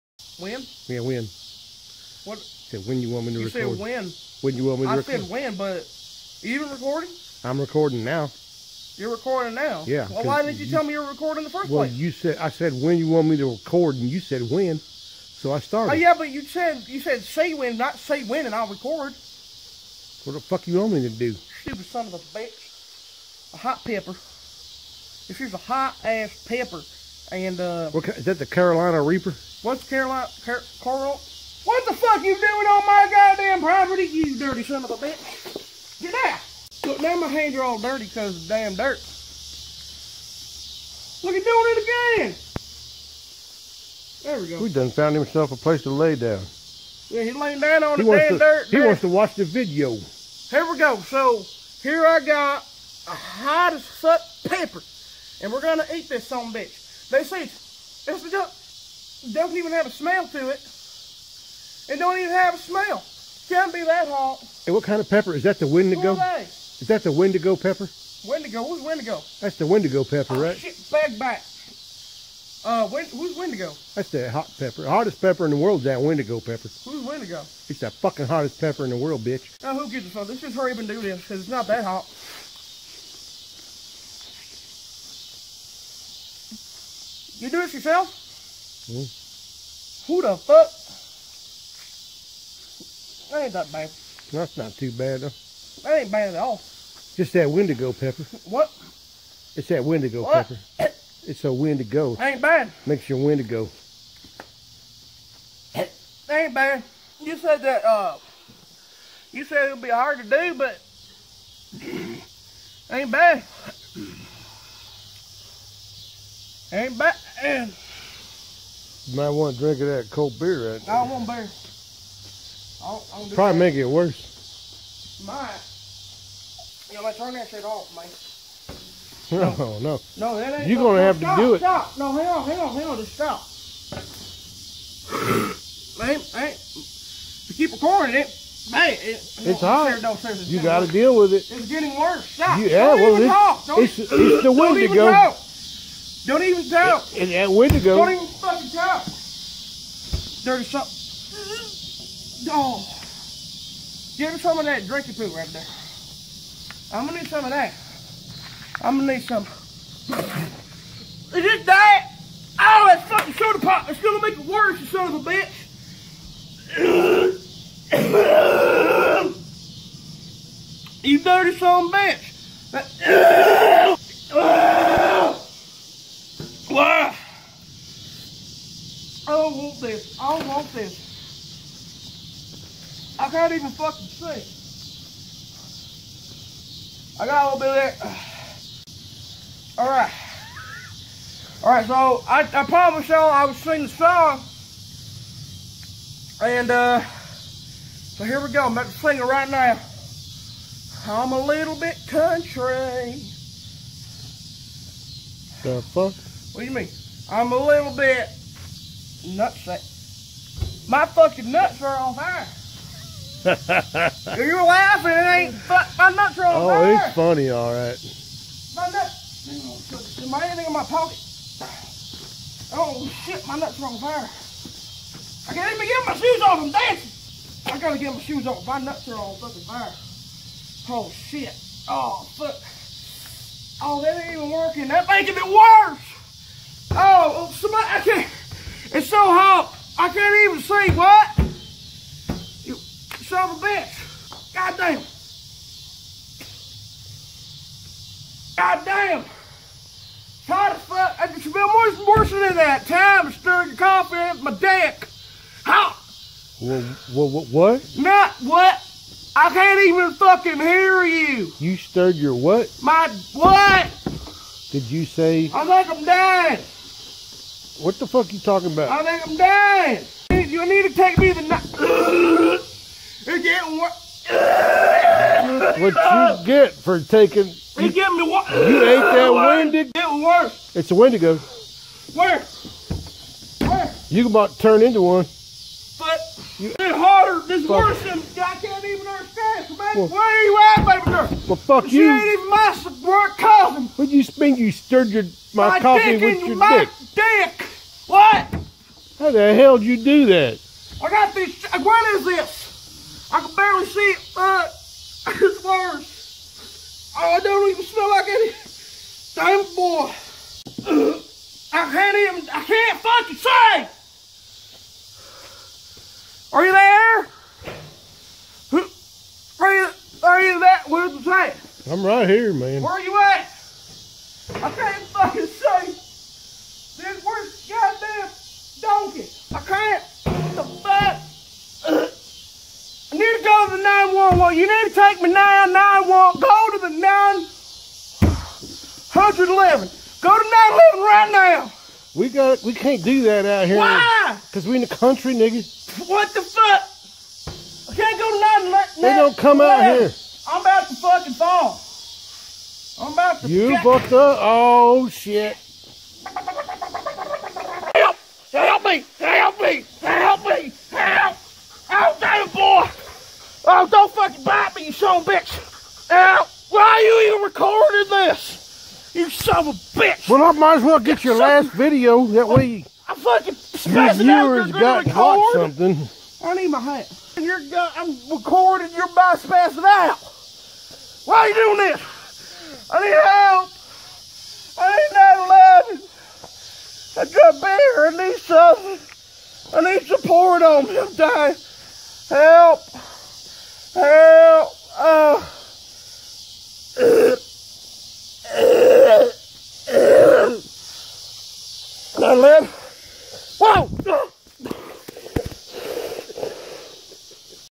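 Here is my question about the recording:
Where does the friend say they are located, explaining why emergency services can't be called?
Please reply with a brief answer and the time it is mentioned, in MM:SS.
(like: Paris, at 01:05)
the country, at 05:44.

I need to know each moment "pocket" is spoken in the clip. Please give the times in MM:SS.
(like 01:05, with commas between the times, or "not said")
03:40.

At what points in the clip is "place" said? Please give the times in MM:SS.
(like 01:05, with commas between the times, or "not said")
00:11, 00:45.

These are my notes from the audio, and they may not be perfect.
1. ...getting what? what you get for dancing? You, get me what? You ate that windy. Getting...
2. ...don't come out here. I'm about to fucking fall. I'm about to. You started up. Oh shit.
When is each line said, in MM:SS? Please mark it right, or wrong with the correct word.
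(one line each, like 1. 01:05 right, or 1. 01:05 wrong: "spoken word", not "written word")
1. 04:33 wrong: "taking", not "dancing"
2. 05:49 wrong: "fucked", not "started".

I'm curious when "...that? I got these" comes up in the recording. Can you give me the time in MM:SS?
05:00.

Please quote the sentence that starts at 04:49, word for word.
So, baby, well, where you at, baby girl?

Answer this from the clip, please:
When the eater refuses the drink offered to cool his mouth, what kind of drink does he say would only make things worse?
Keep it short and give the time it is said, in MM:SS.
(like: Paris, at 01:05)
soda pop, at 02:43.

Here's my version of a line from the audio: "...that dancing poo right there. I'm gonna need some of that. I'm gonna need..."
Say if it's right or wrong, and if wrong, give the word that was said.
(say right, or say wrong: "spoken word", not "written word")
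wrong: "drinking", not "dancing".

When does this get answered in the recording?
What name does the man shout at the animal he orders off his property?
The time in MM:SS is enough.
00:30.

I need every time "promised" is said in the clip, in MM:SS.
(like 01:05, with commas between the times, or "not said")
03:12.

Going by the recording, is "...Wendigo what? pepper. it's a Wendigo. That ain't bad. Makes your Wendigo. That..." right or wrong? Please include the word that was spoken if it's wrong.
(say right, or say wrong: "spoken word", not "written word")
right.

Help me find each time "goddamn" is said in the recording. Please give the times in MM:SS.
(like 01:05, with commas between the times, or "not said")
00:33.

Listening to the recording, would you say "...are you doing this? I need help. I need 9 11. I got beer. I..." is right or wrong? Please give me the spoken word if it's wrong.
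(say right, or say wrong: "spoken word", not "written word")
right.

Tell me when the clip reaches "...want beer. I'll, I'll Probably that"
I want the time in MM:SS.
02:01.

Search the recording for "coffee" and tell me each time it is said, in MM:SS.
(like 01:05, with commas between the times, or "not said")
04:13, 04:55.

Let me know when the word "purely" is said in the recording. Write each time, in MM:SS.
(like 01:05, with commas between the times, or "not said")
not said.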